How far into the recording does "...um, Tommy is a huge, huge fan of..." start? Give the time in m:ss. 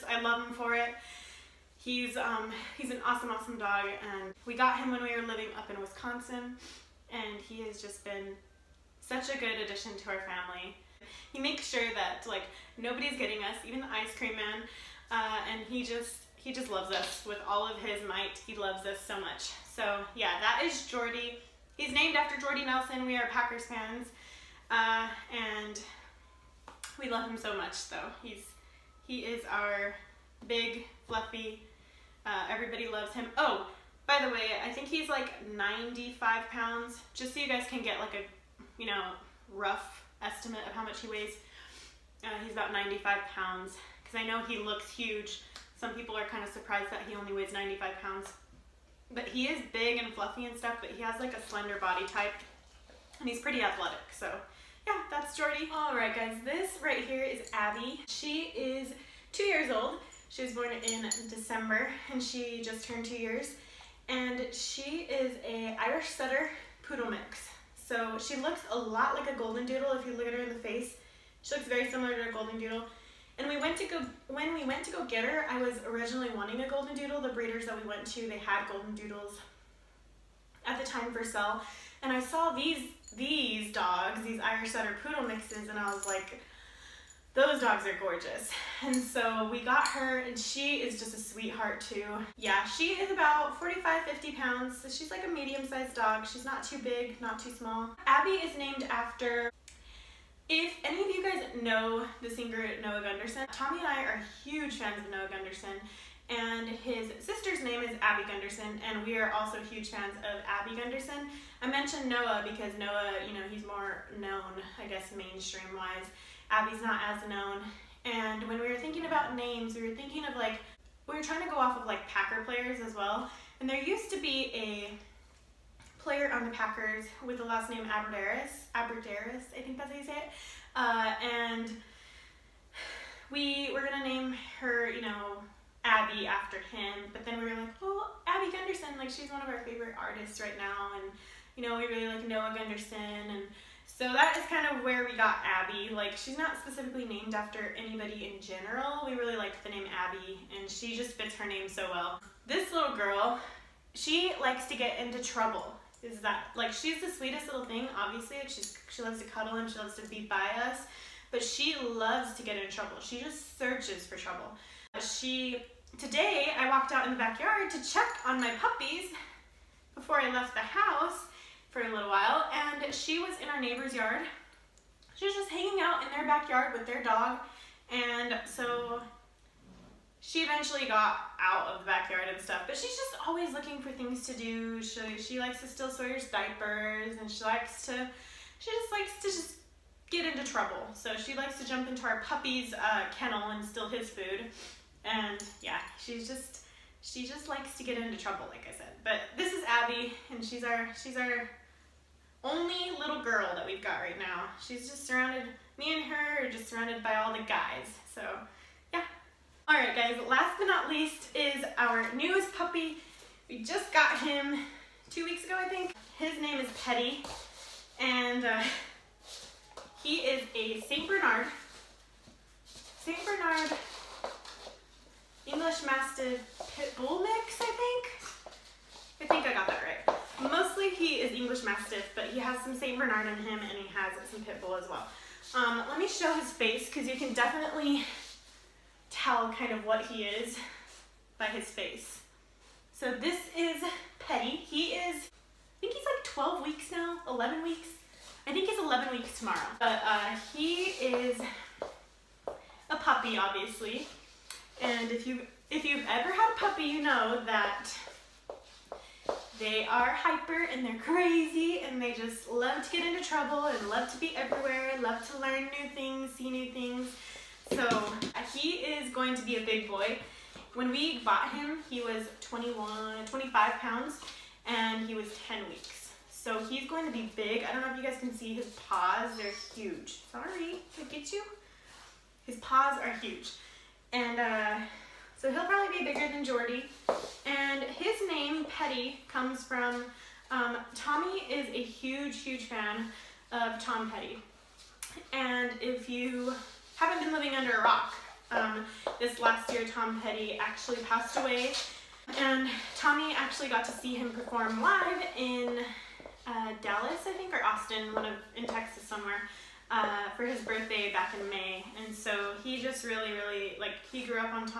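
4:50.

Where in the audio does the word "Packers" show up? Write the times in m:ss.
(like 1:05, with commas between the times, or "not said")
0:23, 2:02, 2:06.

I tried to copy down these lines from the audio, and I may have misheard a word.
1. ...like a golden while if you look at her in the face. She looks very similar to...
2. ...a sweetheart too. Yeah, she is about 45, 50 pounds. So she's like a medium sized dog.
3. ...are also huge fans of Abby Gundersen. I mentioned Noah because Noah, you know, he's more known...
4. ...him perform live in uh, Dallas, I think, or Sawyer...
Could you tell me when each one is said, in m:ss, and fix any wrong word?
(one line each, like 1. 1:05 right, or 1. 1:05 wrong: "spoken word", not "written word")
1. 1:09 wrong: "doodle", not "while"
2. 1:31 right
3. 1:49 right
4. 5:04 wrong: "Austin", not "Sawyer".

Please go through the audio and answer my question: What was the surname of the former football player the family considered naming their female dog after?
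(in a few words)
Abbrederis.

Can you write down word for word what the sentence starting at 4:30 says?
When we bought him, he was 21, 25 pounds and he was 10 weeks.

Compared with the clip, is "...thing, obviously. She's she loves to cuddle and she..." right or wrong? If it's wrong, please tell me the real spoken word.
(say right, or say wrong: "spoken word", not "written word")
right.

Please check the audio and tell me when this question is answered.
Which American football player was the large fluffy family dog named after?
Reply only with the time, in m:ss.
0:22.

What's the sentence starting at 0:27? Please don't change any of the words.
Though so he's he is our big fluffy uh, everybody loves him.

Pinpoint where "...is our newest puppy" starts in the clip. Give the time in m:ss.
3:31.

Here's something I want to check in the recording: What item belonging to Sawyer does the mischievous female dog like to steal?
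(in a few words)
Diapers.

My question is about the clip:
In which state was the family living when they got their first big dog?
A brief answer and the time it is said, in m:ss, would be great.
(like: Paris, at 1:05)
Wisconsin, at 0:05.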